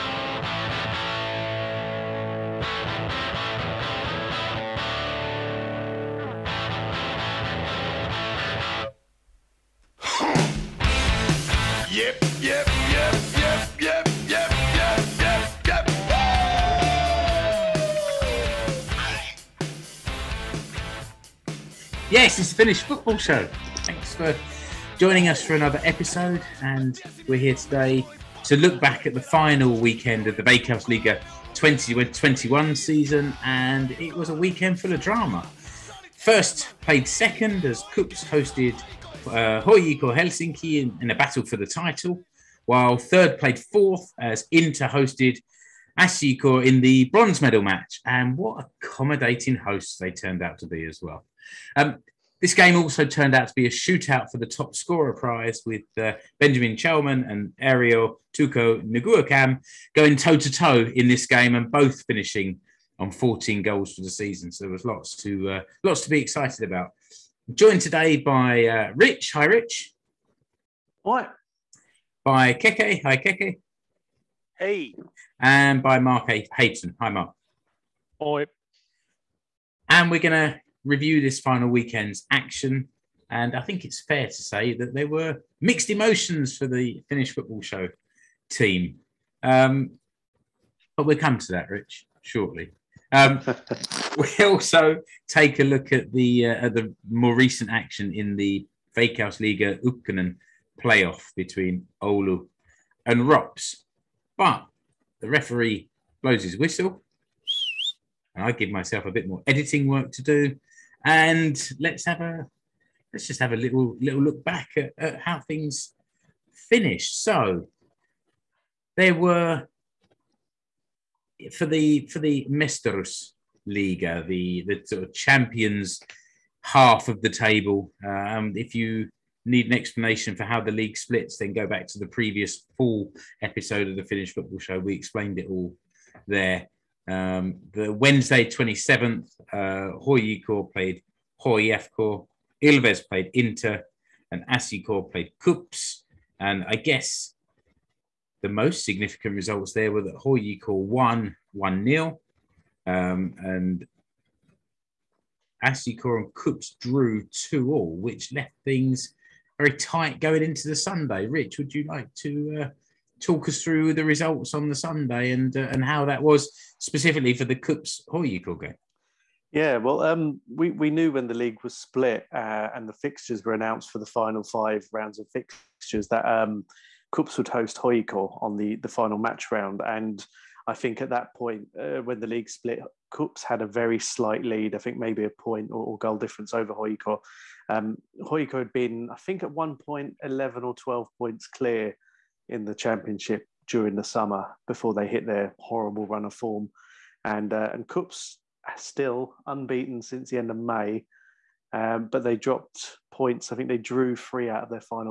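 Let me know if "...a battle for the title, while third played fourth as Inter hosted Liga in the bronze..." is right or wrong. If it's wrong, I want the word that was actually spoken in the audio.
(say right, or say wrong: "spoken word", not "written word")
wrong: "SJK", not "Liga".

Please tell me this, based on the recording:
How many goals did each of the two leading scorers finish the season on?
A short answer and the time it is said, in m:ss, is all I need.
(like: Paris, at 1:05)
14, at 1:03.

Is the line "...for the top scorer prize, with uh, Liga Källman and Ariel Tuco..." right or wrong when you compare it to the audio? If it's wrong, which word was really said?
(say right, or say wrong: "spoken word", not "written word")
wrong: "Benjamin", not "Liga".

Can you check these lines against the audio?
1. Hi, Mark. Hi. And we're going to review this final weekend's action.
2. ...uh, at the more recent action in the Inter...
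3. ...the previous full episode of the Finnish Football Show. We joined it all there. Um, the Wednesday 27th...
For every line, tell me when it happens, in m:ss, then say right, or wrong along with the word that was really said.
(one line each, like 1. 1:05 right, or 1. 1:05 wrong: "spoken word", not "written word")
1. 1:17 right
2. 1:36 wrong: "Veikkausliiga", not "Inter"
3. 2:11 wrong: "explained", not "joined".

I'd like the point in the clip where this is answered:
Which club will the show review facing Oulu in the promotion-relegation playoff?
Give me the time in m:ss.
1:43.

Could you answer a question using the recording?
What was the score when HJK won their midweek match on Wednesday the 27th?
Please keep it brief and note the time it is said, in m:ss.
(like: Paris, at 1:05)
1-0, at 2:31.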